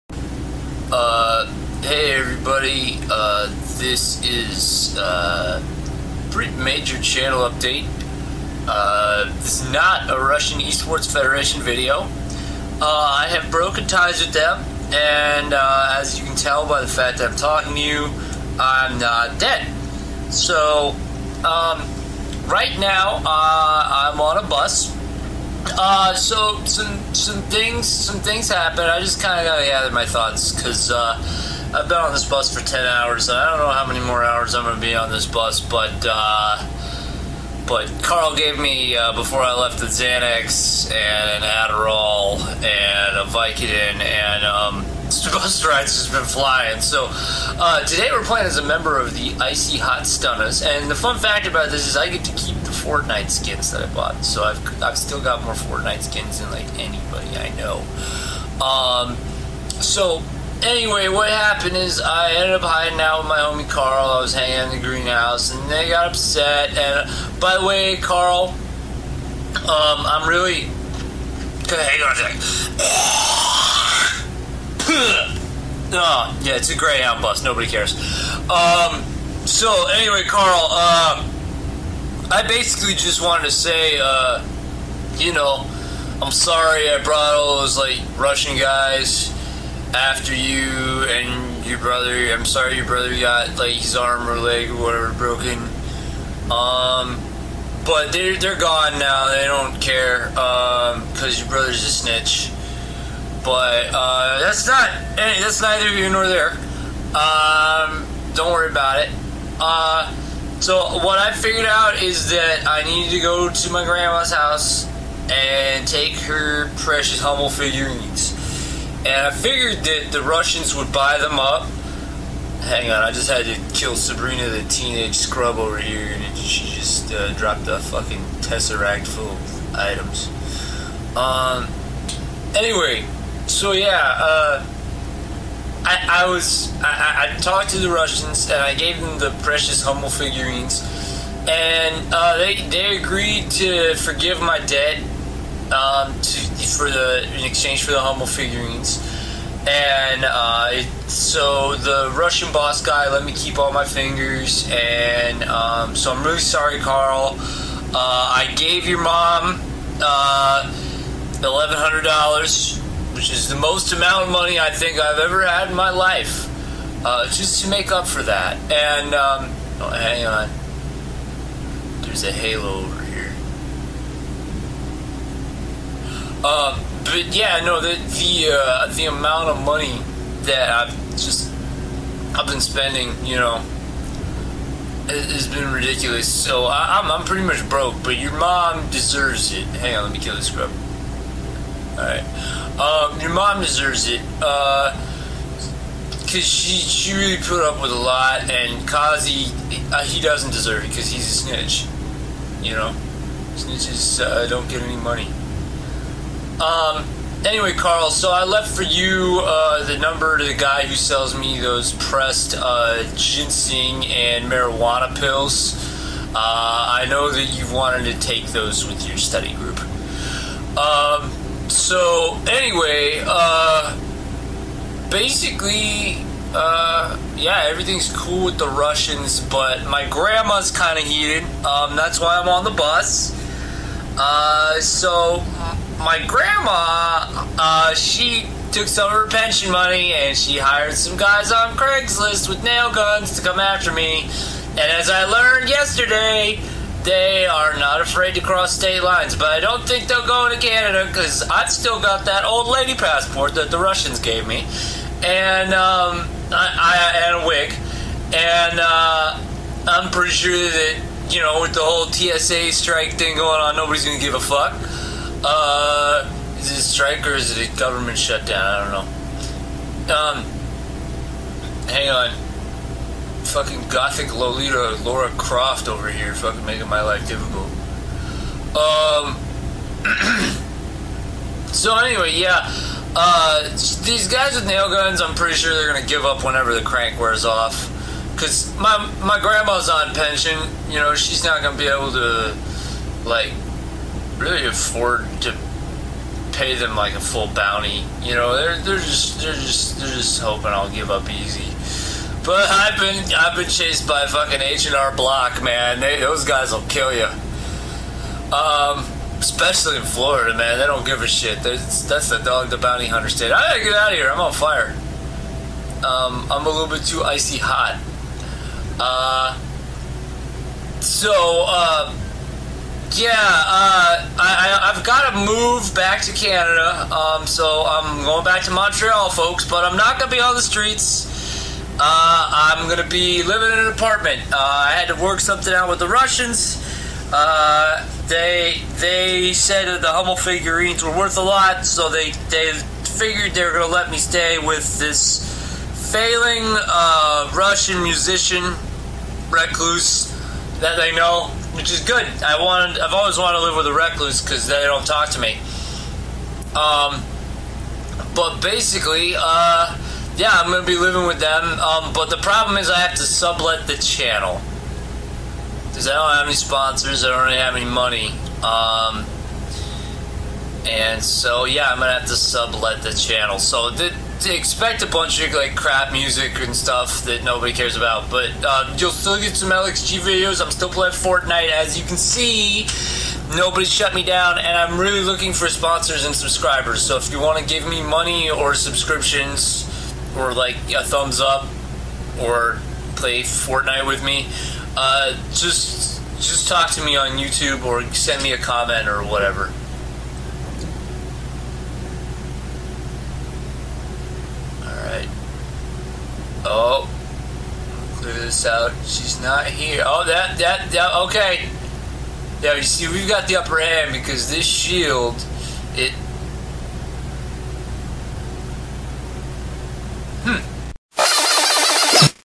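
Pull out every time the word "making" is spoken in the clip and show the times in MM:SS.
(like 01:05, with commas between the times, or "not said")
04:36.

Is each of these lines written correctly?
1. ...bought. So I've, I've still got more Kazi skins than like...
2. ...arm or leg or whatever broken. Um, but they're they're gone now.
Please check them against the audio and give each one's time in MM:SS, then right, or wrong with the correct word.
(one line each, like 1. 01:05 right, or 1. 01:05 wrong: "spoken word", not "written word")
1. 00:53 wrong: "Fortnite", not "Kazi"
2. 01:33 right.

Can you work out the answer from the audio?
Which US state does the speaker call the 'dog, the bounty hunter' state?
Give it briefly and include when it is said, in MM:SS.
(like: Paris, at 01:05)
Florida, at 05:10.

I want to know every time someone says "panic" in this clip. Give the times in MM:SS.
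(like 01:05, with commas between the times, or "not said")
not said.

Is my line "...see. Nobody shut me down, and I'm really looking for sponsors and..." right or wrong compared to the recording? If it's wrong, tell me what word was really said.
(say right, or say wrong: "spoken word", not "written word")
right.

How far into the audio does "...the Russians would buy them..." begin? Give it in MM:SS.
02:00.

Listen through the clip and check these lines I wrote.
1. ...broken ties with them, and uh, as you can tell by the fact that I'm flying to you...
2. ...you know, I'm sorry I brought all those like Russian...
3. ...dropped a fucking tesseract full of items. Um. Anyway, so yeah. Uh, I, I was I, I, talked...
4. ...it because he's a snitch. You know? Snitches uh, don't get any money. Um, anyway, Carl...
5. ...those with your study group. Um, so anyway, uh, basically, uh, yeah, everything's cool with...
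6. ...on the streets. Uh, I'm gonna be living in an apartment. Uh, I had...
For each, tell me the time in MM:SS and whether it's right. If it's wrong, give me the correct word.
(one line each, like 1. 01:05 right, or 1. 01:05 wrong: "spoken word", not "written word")
1. 00:13 wrong: "talking", not "flying"
2. 01:25 right
3. 02:07 right
4. 03:20 right
5. 03:38 right
6. 05:30 right.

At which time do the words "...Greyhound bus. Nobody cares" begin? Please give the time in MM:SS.
01:16.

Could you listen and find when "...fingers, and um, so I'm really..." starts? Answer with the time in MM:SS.
02:33.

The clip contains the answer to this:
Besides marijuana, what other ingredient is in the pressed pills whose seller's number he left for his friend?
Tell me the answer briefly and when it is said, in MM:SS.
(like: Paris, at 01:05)
ginseng, at 03:33.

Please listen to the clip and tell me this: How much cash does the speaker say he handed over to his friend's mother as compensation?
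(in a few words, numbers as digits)
1100 dollars.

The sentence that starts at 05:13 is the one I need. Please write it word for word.
I gotta get out of here.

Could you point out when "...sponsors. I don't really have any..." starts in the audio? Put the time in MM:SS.
06:06.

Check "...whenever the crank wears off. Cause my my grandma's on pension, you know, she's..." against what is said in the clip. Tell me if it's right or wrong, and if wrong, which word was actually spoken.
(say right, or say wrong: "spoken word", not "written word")
right.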